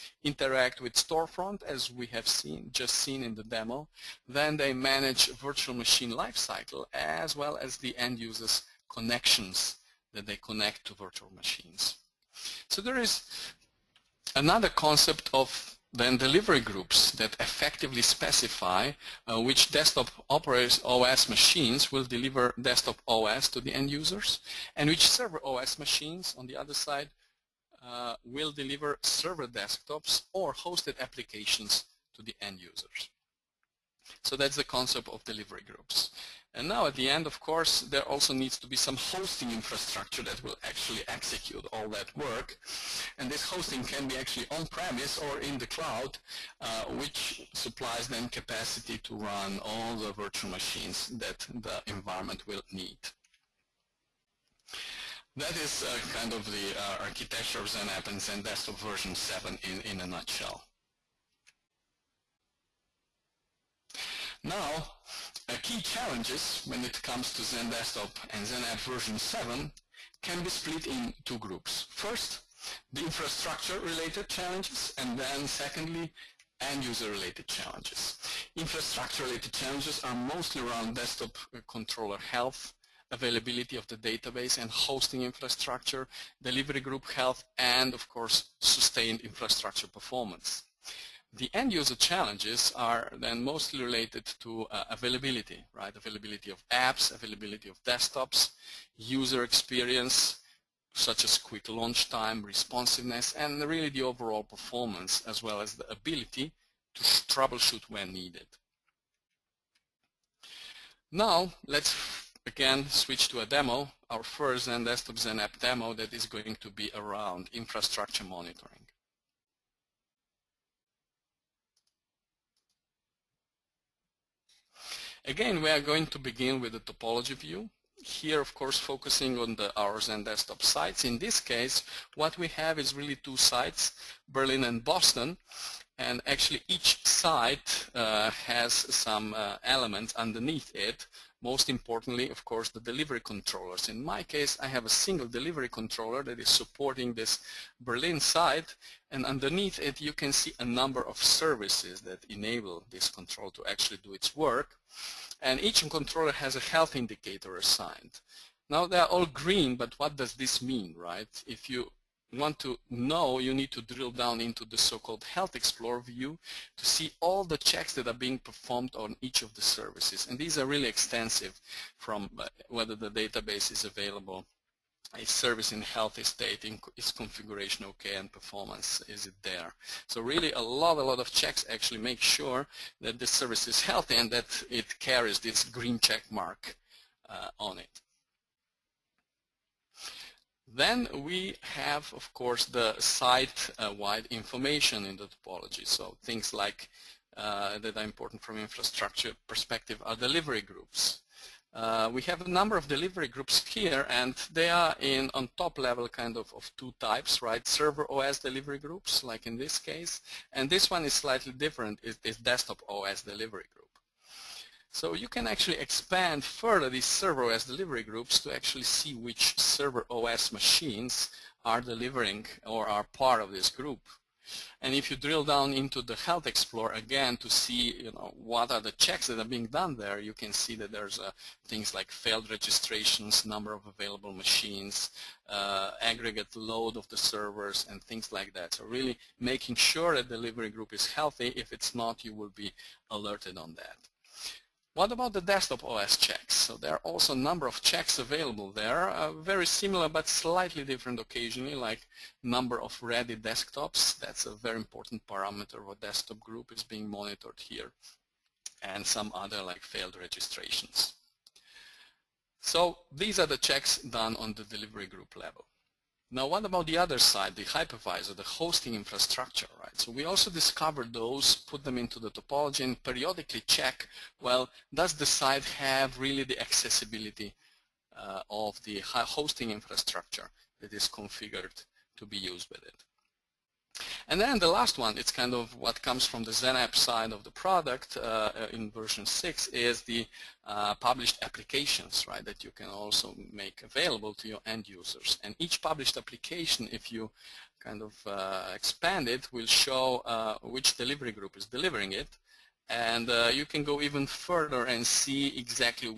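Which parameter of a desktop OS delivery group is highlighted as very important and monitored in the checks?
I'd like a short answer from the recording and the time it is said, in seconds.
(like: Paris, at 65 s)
number of ready desktops, at 252 s.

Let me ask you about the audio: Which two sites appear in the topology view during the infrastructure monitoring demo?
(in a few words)
Berlin and Boston.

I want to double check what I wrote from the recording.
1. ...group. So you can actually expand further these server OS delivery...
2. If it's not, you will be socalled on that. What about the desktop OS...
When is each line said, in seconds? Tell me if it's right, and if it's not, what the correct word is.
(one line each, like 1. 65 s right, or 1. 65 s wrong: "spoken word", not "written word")
1. 213 s right
2. 241 s wrong: "alerted", not "socalled".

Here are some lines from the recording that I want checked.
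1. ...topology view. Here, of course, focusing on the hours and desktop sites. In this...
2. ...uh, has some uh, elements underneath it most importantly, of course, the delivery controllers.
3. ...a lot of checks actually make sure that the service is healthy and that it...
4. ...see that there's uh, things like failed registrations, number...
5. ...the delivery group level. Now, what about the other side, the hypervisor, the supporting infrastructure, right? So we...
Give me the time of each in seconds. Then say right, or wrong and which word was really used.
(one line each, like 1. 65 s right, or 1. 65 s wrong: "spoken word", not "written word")
1. 126 s right
2. 137 s right
3. 180 s right
4. 230 s right
5. 264 s wrong: "hosting", not "supporting".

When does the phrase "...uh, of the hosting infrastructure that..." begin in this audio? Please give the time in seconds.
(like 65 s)
278 s.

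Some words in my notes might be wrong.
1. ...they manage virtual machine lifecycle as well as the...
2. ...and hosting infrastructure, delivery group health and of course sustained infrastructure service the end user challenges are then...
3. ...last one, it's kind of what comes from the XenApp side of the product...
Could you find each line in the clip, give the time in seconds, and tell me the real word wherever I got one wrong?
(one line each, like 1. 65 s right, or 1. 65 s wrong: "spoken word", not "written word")
1. 4 s right
2. 84 s wrong: "performance", not "service"
3. 284 s right.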